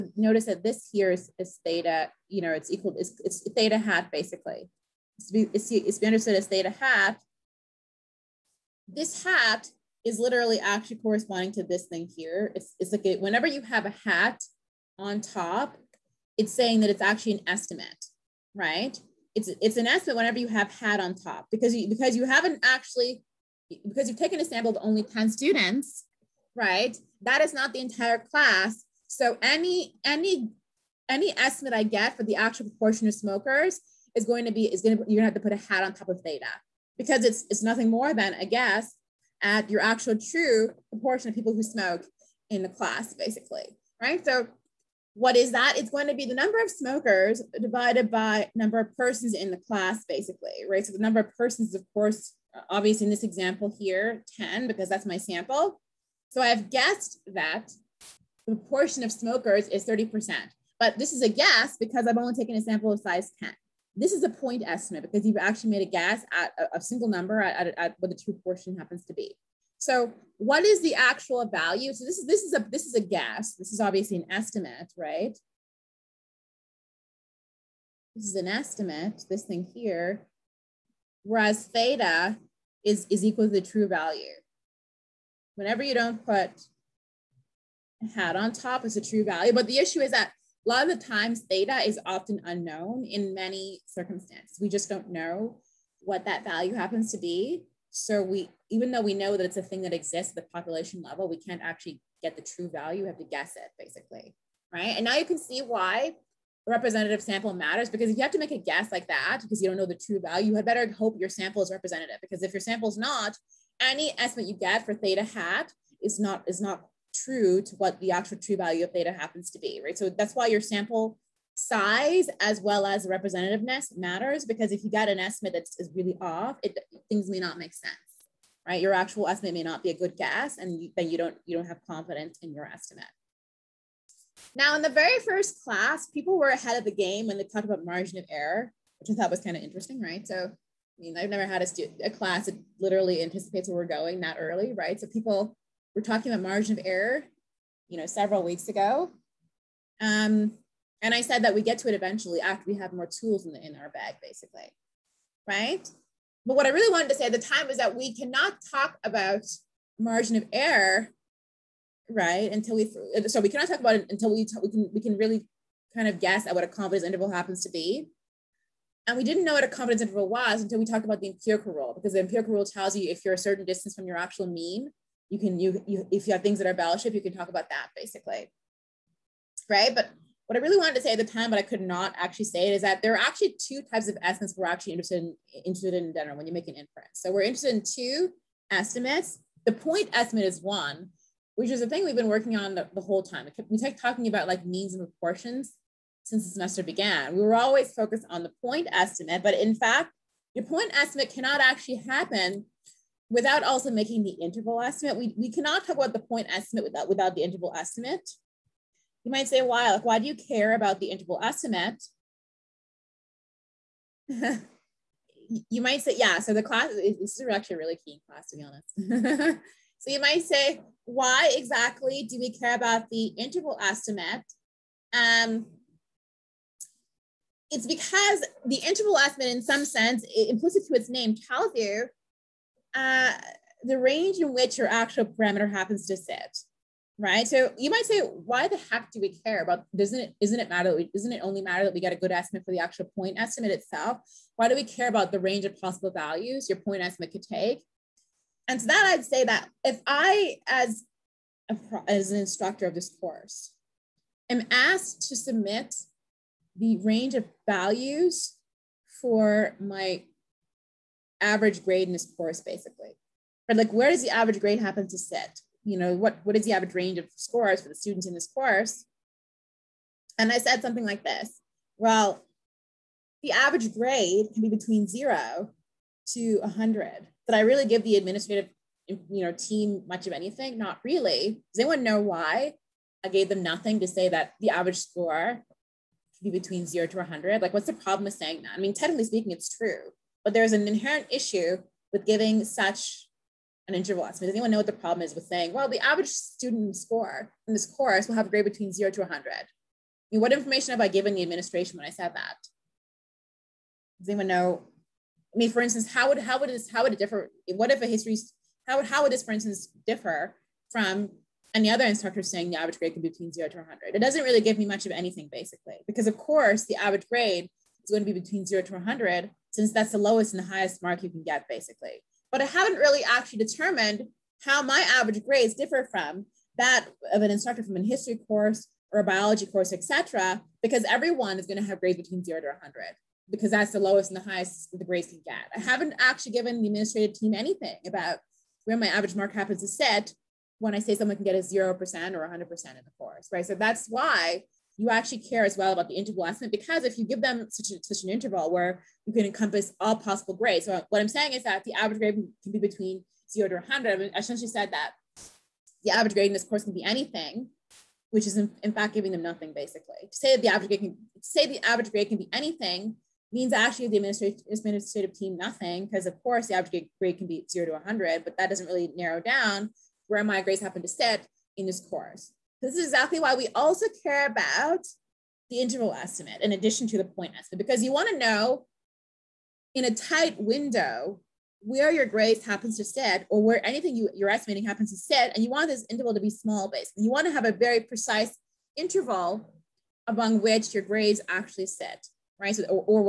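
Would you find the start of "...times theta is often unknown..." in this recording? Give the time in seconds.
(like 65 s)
91 s.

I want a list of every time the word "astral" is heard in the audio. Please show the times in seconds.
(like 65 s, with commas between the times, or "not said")
not said.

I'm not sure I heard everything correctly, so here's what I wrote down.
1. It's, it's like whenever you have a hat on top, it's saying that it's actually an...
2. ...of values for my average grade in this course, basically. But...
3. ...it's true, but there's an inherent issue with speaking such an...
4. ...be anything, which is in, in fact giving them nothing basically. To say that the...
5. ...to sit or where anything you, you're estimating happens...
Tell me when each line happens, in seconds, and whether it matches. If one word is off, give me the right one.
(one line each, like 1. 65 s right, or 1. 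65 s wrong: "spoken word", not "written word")
1. 12 s right
2. 257 s right
3. 289 s wrong: "giving", not "speaking"
4. 356 s right
5. 382 s right.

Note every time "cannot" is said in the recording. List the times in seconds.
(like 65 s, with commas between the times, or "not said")
158 s, 163 s, 201 s, 205 s.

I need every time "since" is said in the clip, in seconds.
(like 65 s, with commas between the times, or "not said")
196 s, 319 s.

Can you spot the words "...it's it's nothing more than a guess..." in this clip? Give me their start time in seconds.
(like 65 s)
37 s.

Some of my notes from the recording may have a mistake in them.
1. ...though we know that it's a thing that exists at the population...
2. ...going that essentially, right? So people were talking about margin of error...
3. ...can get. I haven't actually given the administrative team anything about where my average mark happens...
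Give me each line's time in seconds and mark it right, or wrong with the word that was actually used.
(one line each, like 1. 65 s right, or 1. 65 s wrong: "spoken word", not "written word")
1. 98 s right
2. 143 s wrong: "early", not "essentially"
3. 335 s right.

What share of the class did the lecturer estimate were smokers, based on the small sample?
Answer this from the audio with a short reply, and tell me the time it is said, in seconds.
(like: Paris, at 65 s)
30%, at 59 s.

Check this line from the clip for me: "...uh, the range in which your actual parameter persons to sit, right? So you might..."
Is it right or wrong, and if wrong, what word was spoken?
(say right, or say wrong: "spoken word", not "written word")
wrong: "happens", not "persons".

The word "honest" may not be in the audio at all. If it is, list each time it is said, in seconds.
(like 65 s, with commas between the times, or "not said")
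218 s.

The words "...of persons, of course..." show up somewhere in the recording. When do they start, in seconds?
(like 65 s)
51 s.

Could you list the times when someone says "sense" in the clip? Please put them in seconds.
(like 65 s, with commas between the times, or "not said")
127 s, 229 s.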